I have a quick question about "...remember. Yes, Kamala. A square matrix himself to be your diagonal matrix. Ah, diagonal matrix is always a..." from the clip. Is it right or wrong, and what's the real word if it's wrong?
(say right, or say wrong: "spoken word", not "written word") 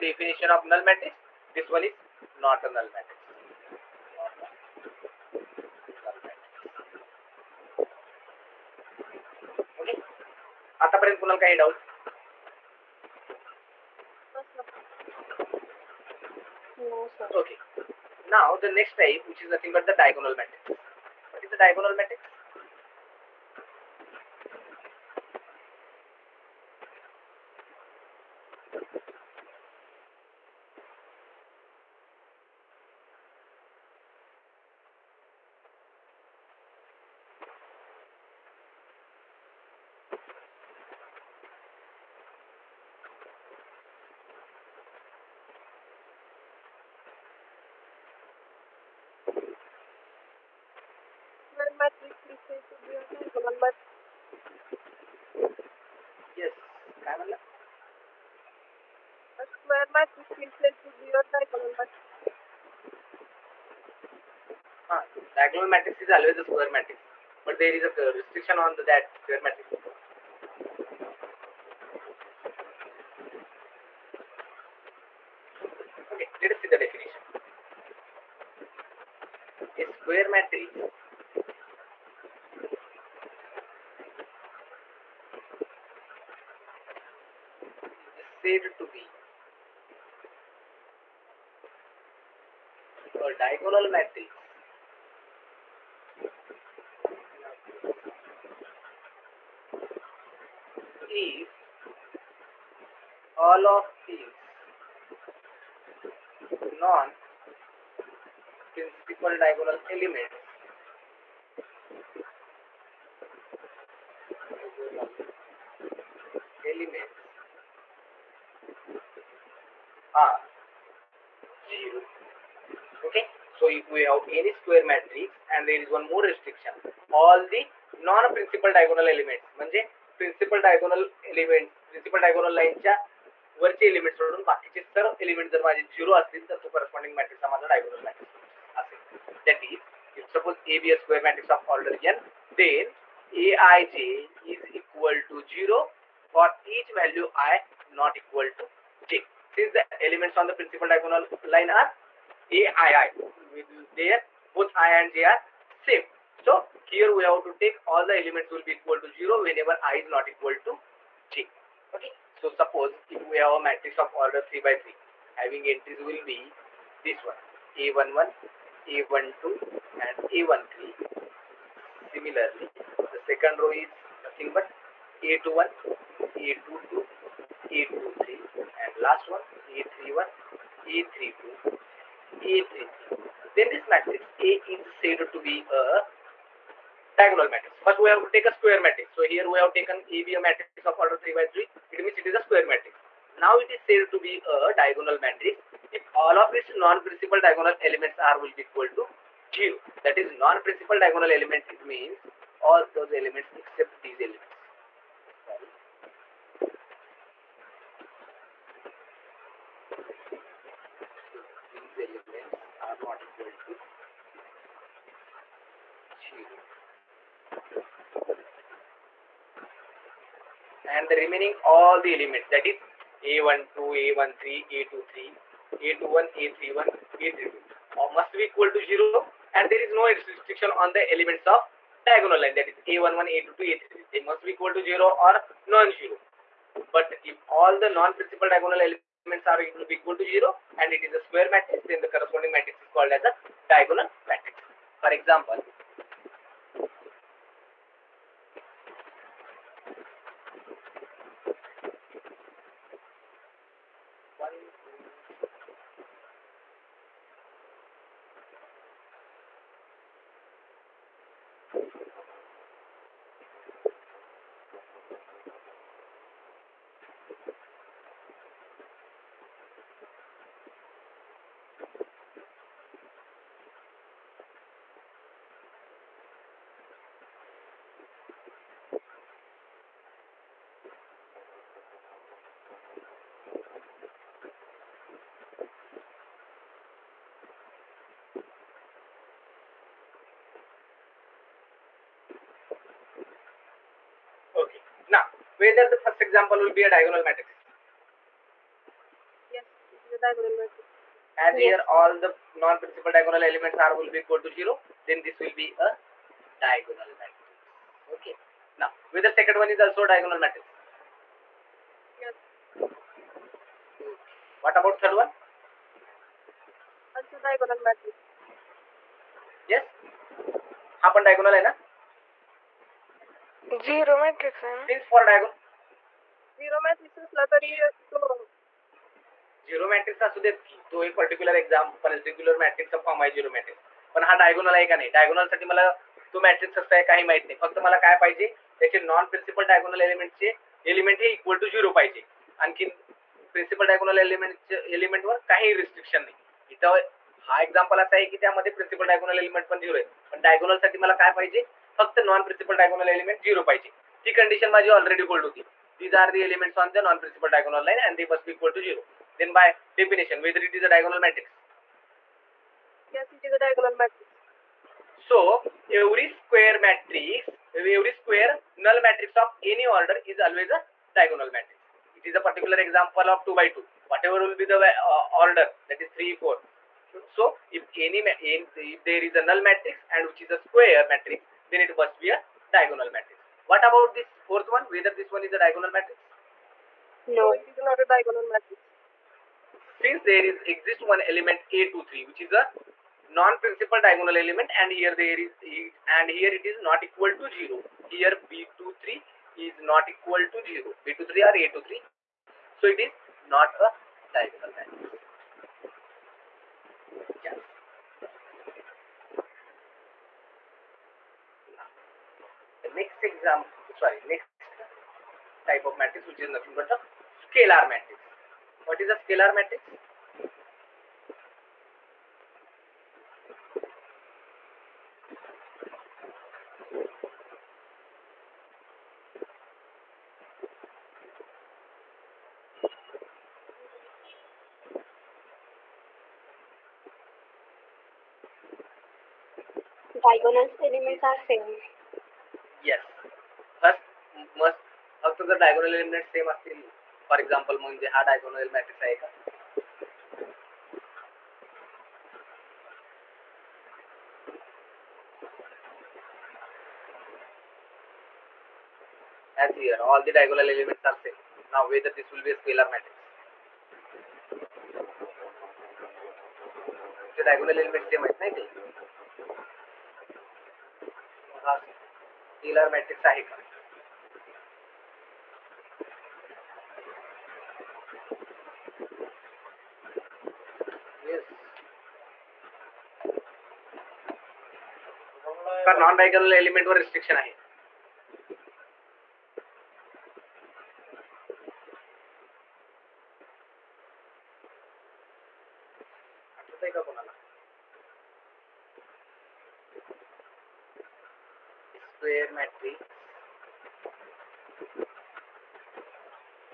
right.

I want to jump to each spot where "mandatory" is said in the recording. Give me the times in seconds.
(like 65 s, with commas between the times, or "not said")
not said.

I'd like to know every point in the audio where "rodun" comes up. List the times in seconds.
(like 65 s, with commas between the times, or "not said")
134 s.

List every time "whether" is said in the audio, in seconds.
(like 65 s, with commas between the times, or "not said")
295 s, 309 s, 384 s, 461 s.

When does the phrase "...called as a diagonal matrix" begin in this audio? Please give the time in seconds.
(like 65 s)
242 s.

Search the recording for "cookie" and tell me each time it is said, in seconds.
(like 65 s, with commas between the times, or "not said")
not said.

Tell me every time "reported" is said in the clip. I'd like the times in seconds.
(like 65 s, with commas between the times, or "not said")
not said.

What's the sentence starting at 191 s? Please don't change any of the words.
It means it is a square matrix.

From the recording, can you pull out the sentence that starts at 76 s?
Okay, let us see the definition.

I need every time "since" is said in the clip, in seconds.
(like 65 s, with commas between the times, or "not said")
149 s, 389 s.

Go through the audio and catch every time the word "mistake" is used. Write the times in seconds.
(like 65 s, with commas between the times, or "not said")
52 s.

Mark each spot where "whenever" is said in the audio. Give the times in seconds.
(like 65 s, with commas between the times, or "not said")
159 s.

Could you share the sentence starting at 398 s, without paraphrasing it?
Here B23 is not equal to zero.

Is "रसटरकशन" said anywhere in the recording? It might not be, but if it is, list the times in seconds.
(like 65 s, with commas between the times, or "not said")
345 s, 486 s.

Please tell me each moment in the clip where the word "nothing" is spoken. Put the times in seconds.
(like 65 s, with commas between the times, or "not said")
19 s, 174 s, 416 s.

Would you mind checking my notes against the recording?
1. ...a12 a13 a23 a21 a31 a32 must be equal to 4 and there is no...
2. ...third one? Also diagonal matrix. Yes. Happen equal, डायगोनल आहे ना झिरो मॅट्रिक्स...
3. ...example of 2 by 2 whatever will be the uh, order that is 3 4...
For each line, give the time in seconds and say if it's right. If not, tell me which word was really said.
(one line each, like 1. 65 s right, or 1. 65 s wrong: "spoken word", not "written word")
1. 223 s wrong: "0", not "4"
2. 315 s wrong: "diagonal", not "equal"
3. 372 s right.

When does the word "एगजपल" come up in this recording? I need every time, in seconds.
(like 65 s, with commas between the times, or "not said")
447 s.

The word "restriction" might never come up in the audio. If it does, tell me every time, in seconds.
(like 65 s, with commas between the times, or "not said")
68 s, 126 s, 230 s.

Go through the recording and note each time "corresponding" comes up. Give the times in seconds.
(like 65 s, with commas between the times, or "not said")
136 s, 242 s.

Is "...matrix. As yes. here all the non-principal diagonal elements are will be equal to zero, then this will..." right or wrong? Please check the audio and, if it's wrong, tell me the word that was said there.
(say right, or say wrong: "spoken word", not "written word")
right.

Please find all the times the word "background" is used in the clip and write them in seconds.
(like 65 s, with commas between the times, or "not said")
not said.